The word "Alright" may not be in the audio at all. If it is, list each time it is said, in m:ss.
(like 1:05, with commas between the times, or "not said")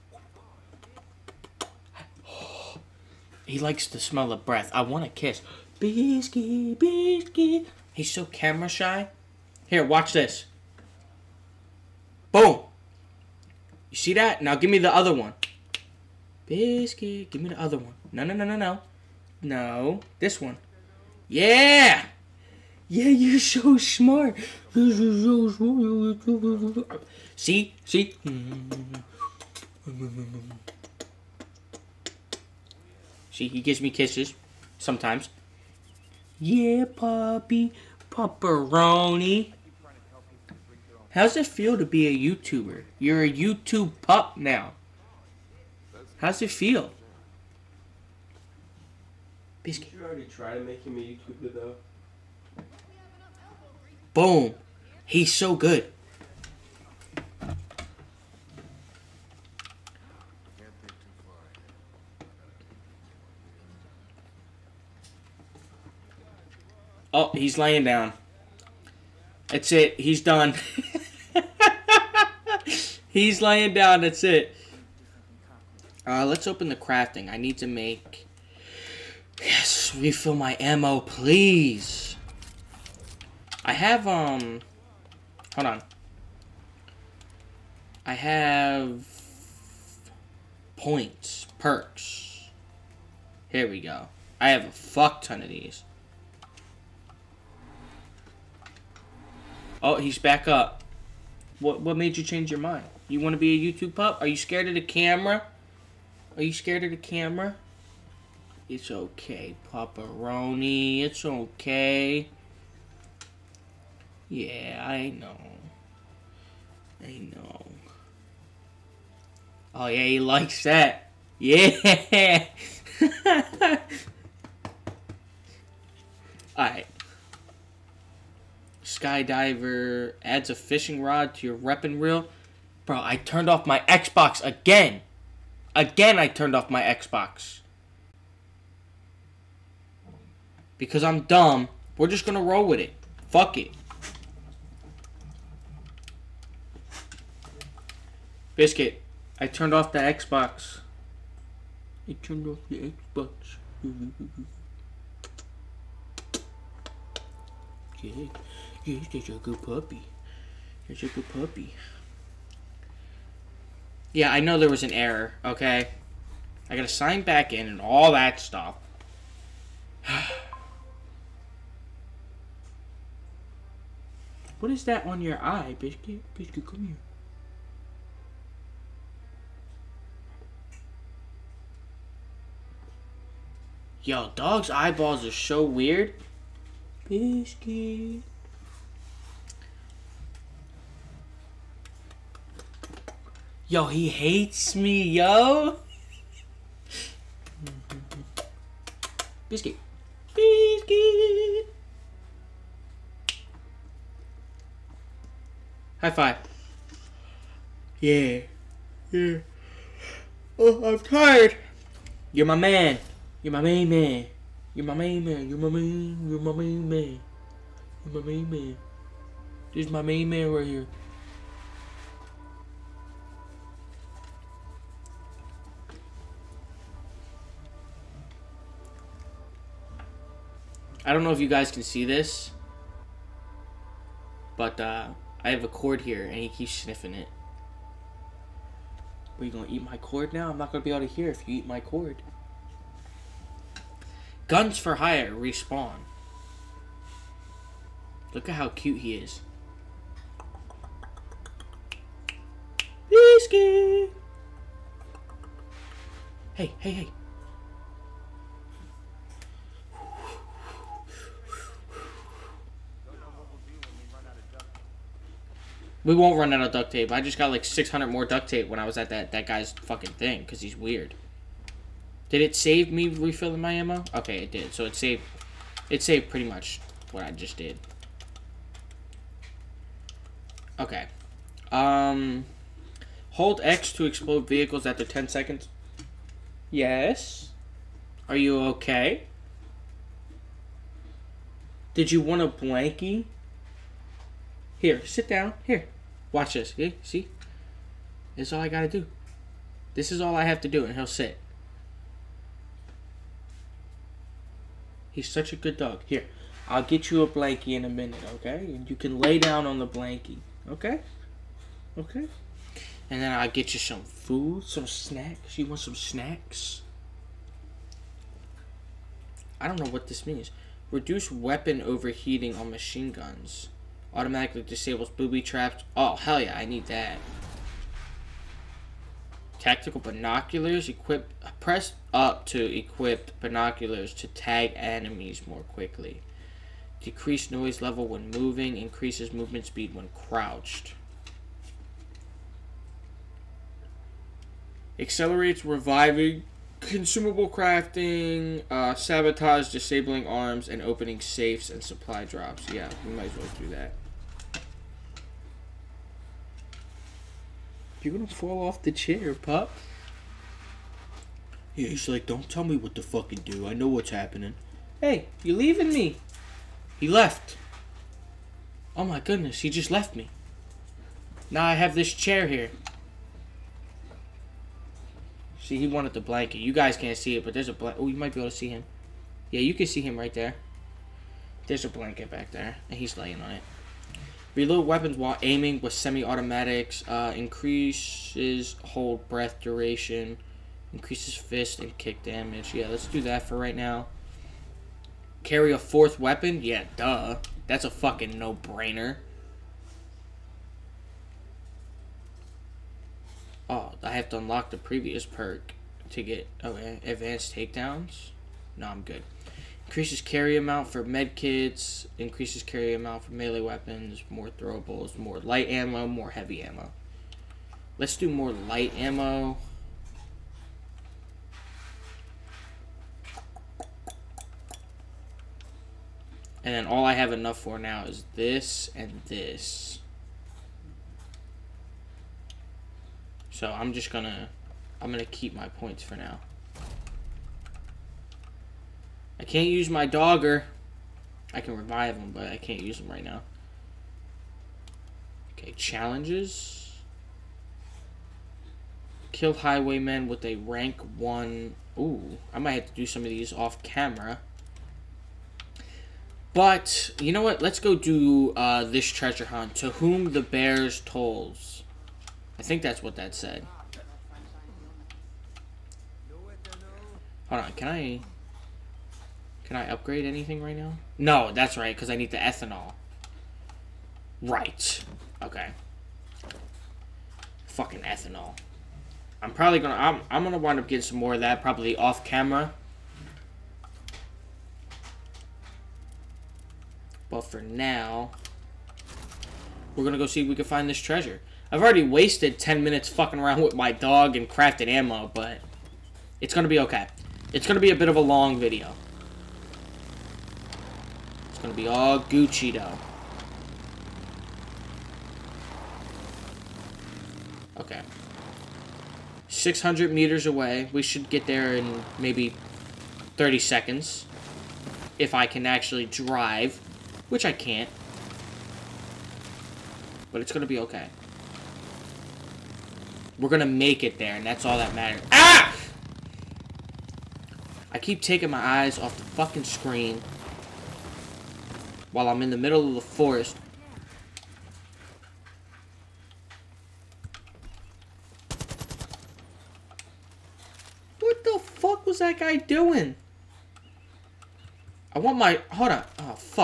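2:06.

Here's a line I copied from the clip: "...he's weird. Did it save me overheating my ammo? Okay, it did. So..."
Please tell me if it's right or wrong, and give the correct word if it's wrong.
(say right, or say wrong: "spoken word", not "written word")
wrong: "refilling", not "overheating".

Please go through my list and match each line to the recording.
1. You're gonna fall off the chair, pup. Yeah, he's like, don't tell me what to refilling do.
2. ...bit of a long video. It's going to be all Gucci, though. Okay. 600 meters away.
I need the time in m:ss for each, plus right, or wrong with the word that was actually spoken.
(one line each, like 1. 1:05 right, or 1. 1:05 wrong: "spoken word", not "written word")
1. 5:58 wrong: "fucking", not "refilling"
2. 8:17 right.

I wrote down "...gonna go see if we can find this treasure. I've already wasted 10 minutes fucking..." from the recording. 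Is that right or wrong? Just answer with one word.
right.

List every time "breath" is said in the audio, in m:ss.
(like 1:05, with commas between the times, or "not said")
0:04, 6:29.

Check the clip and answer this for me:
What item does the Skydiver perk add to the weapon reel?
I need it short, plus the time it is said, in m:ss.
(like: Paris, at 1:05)
fishing rod, at 2:10.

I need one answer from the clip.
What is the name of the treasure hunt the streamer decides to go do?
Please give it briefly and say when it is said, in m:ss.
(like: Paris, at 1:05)
To whom the bears tolls, at 7:39.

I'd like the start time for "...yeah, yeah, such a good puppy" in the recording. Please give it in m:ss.
2:38.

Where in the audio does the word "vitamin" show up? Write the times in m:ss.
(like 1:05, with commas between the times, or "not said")
not said.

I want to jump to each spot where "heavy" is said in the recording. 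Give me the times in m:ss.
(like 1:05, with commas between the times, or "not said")
6:56.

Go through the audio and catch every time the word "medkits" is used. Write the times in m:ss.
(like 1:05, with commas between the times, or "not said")
6:51.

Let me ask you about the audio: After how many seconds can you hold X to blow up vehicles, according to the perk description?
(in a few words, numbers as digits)
10 seconds.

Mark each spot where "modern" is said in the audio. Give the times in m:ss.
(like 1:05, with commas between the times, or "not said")
not said.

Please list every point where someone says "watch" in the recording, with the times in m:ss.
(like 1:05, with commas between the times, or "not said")
0:09, 4:56.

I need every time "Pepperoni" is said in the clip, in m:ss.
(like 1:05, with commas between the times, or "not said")
0:38, 1:49.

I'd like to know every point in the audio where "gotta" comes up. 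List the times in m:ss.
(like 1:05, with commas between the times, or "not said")
2:46, 4:58.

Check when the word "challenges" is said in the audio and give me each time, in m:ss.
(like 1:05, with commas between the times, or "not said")
7:25.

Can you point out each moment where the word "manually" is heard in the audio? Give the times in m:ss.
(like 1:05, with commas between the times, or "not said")
not said.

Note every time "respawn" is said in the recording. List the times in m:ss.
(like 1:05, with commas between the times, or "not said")
4:05.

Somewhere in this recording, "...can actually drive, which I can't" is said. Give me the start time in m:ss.
8:35.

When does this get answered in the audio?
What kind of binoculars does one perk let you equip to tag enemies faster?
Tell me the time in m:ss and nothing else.
5:29.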